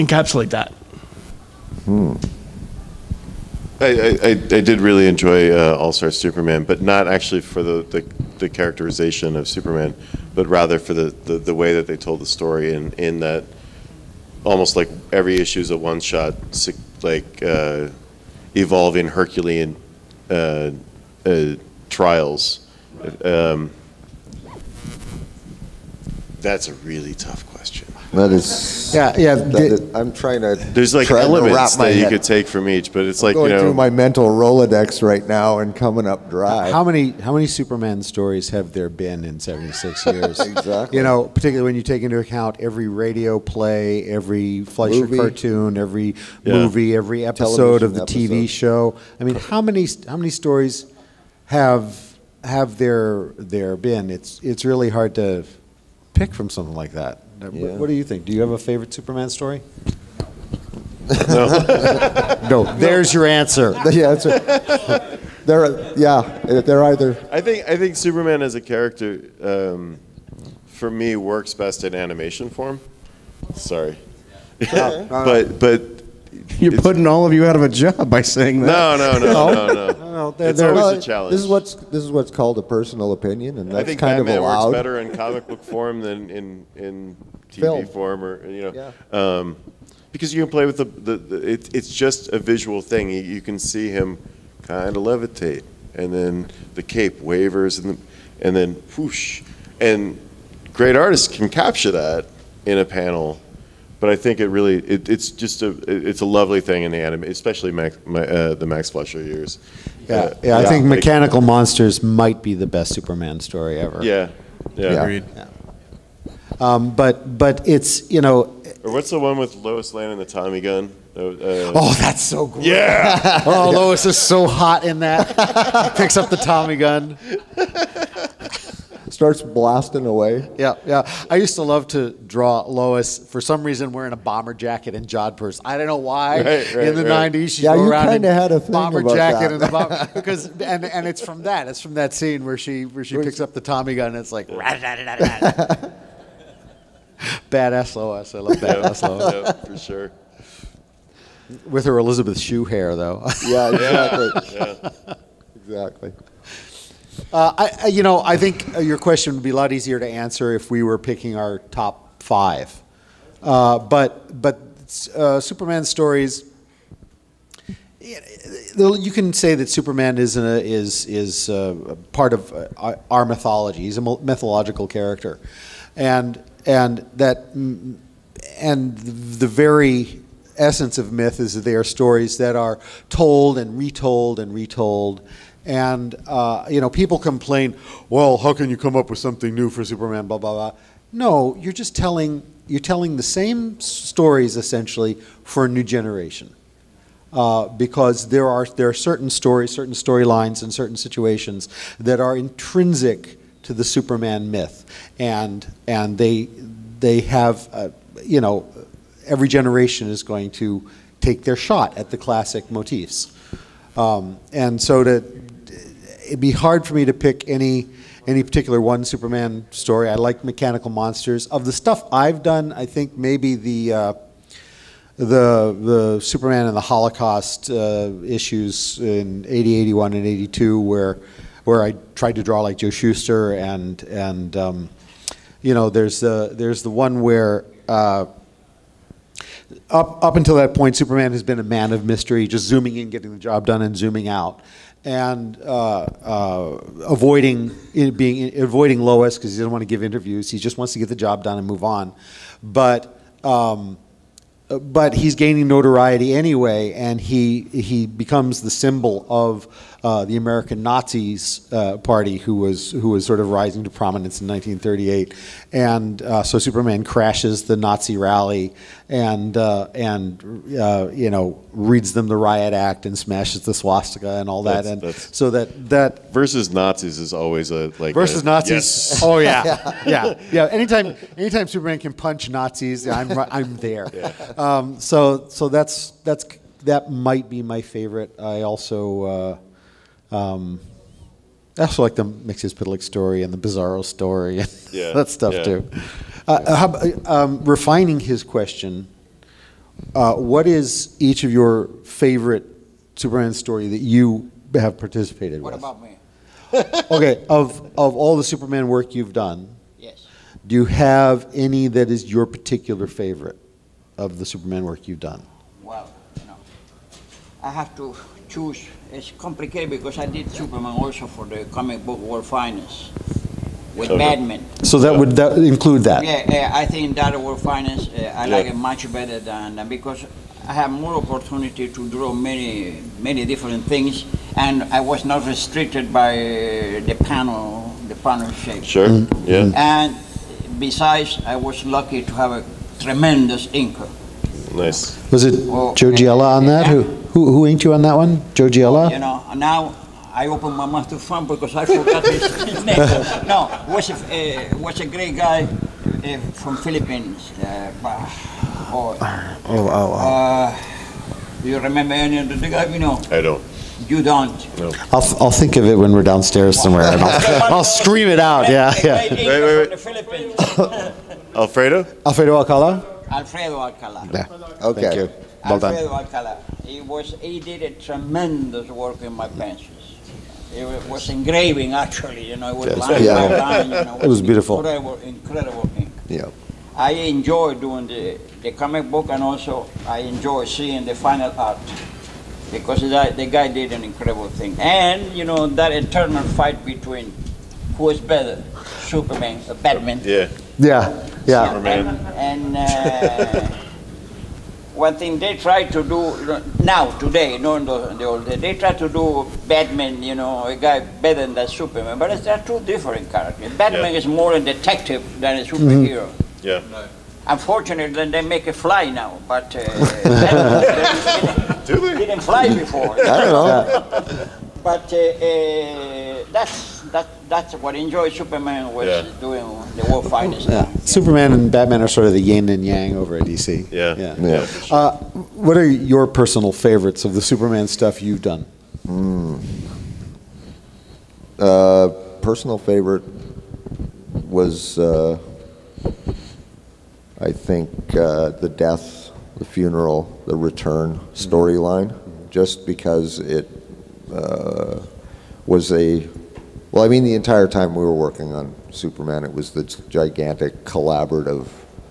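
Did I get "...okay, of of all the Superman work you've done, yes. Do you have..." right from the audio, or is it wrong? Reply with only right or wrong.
right.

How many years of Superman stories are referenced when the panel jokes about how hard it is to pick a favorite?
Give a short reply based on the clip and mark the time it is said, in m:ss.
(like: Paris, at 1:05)
76, at 0:39.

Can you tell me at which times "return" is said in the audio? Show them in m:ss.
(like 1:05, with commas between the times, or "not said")
7:30.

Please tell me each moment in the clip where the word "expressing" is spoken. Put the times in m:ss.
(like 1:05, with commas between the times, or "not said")
not said.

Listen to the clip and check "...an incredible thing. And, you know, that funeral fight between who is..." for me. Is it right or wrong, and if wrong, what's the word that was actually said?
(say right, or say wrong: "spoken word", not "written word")
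wrong: "eternal", not "funeral".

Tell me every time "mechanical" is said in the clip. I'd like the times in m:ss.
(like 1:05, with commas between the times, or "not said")
1:50, 3:40.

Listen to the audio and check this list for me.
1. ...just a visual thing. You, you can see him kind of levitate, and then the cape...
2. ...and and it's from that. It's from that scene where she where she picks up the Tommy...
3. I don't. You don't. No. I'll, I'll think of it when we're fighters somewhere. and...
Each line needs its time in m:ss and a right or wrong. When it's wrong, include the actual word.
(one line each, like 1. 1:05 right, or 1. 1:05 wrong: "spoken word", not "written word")
1. 1:31 right
2. 2:20 right
3. 6:03 wrong: "downstairs", not "fighters".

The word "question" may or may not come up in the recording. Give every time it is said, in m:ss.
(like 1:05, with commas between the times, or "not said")
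0:27, 2:38, 4:58.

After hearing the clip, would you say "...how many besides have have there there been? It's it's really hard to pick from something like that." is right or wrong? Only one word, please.
wrong.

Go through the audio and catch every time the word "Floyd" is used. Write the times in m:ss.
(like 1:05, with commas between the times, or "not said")
not said.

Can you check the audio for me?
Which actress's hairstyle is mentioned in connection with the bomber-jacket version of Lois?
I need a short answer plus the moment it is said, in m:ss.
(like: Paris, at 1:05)
Elizabeth Shue, at 2:31.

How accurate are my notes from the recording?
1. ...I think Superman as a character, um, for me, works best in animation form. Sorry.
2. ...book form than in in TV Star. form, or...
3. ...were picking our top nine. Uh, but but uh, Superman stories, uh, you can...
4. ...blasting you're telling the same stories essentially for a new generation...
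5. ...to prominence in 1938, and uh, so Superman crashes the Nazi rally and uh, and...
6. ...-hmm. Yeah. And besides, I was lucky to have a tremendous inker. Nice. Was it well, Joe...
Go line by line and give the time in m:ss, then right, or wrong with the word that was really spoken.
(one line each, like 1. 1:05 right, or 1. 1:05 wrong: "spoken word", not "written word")
1. 1:07 right
2. 1:25 wrong: "Film", not "Star"
3. 2:40 wrong: "five", not "nine"
4. 3:11 wrong: "telling", not "blasting"
5. 4:23 right
6. 5:39 right.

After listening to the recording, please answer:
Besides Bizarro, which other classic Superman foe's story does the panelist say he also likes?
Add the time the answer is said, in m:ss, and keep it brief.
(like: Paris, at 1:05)
Mxyzptlk, at 4:52.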